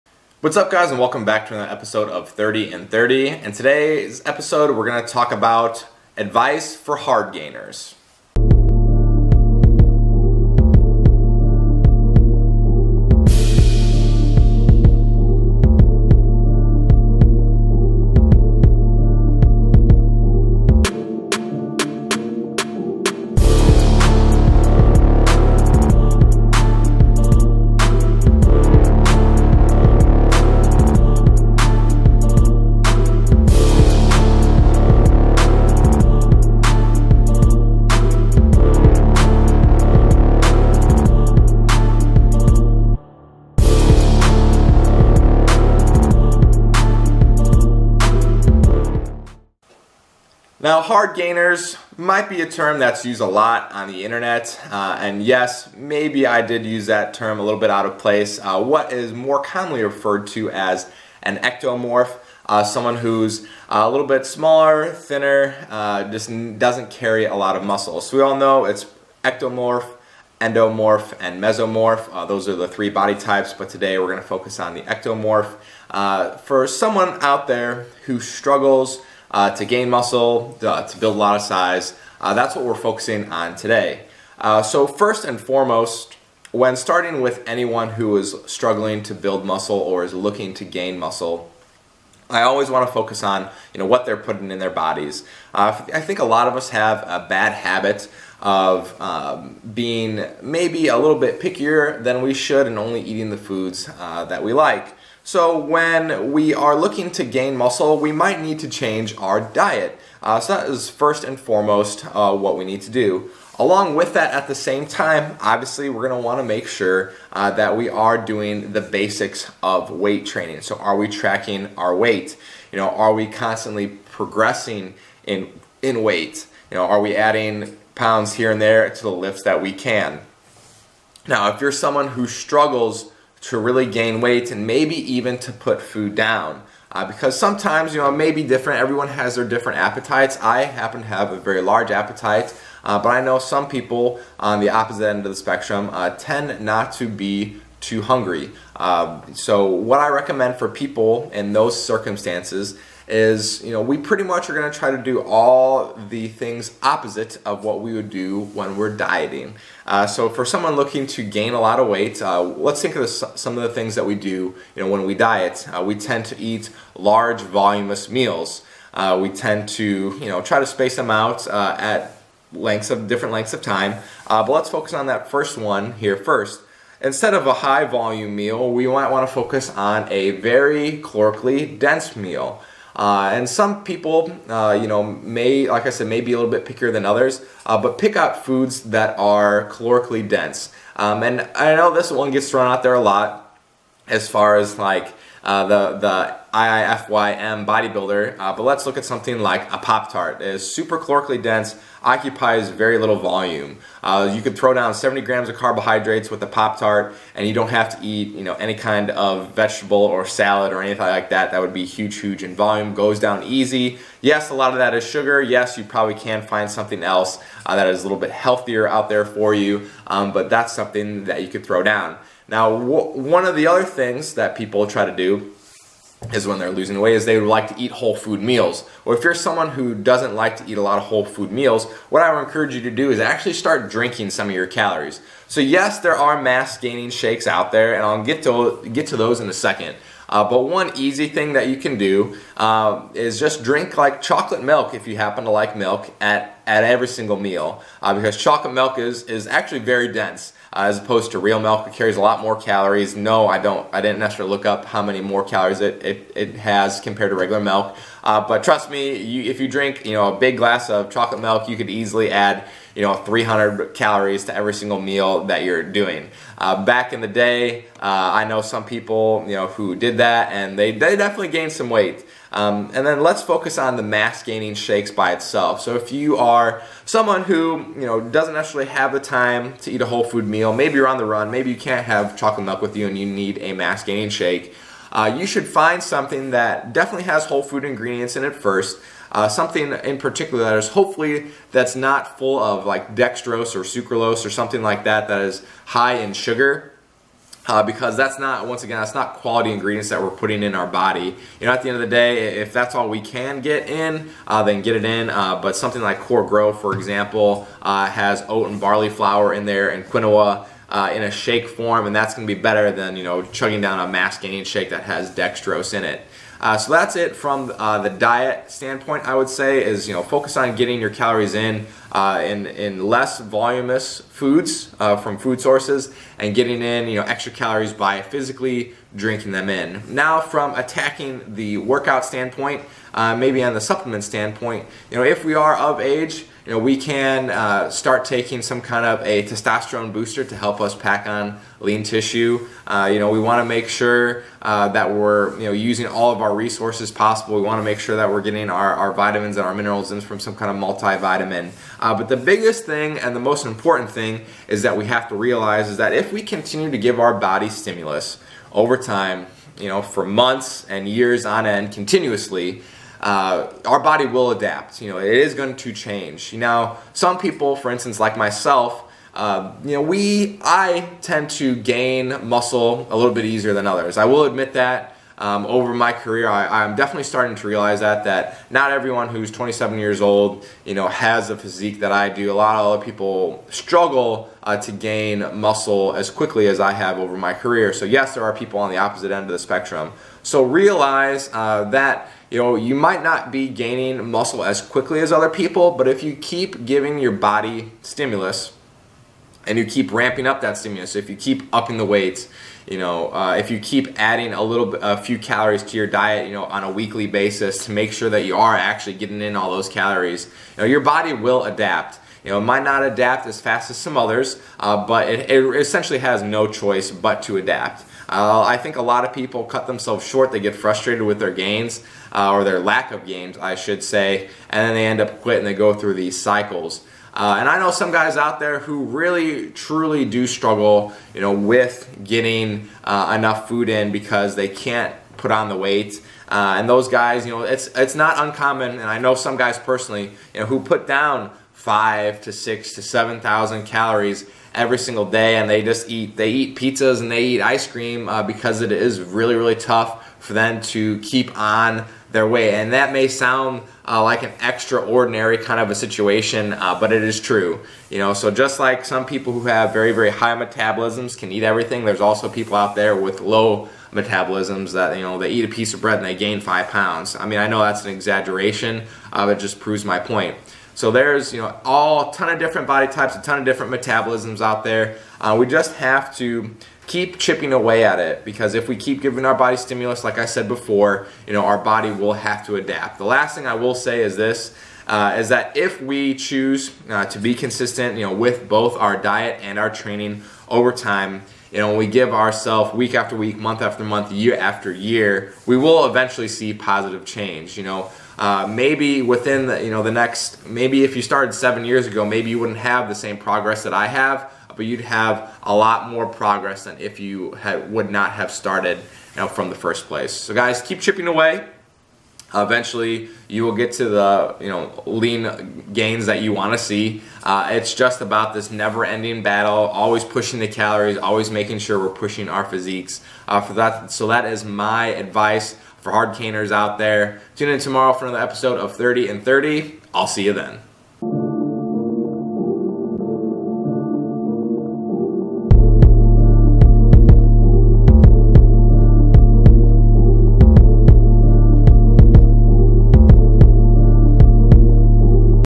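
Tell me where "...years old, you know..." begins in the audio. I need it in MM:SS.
06:19.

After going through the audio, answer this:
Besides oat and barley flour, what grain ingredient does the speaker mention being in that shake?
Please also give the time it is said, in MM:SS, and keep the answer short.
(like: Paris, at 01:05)
quinoa, at 05:10.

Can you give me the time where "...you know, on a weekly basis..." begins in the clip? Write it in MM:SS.
06:46.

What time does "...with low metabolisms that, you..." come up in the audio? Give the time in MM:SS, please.
07:43.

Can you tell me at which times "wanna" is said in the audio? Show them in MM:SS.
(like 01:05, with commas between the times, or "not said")
01:56.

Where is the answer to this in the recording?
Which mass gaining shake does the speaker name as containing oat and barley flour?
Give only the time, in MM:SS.
05:06.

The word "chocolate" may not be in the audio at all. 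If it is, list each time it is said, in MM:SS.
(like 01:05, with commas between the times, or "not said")
04:04, 04:08, 04:21, 04:42.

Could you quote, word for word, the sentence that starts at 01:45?
So when we are looking to gain muscle, we might need to change our diet.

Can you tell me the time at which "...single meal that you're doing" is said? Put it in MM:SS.
04:24.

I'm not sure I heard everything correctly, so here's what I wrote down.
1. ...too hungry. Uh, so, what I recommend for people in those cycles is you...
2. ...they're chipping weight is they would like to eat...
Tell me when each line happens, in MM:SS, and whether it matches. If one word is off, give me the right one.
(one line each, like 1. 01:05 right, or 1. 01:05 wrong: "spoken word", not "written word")
1. 02:27 wrong: "circumstances", not "cycles"
2. 03:46 wrong: "losing", not "chipping".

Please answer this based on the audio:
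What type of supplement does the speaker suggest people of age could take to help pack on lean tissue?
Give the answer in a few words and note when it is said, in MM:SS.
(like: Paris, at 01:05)
testosterone booster, at 05:39.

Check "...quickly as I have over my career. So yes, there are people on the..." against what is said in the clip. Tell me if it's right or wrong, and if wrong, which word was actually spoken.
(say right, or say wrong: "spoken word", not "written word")
right.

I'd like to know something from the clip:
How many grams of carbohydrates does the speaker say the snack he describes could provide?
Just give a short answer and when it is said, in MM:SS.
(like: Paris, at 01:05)
70, at 03:24.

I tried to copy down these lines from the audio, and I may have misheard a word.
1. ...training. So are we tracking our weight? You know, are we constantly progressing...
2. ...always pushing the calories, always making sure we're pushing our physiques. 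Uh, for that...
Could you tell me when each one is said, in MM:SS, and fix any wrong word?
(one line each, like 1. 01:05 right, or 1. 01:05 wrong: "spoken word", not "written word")
1. 02:00 right
2. 08:39 right.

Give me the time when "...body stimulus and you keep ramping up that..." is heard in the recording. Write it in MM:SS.
06:37.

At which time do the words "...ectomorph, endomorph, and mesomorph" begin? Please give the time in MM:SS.
01:09.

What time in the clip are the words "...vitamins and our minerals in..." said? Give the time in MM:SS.
05:49.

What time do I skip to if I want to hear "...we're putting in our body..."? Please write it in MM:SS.
05:00.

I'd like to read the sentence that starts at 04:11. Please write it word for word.
It carries a lot more calories.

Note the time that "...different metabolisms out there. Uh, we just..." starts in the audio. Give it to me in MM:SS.
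07:53.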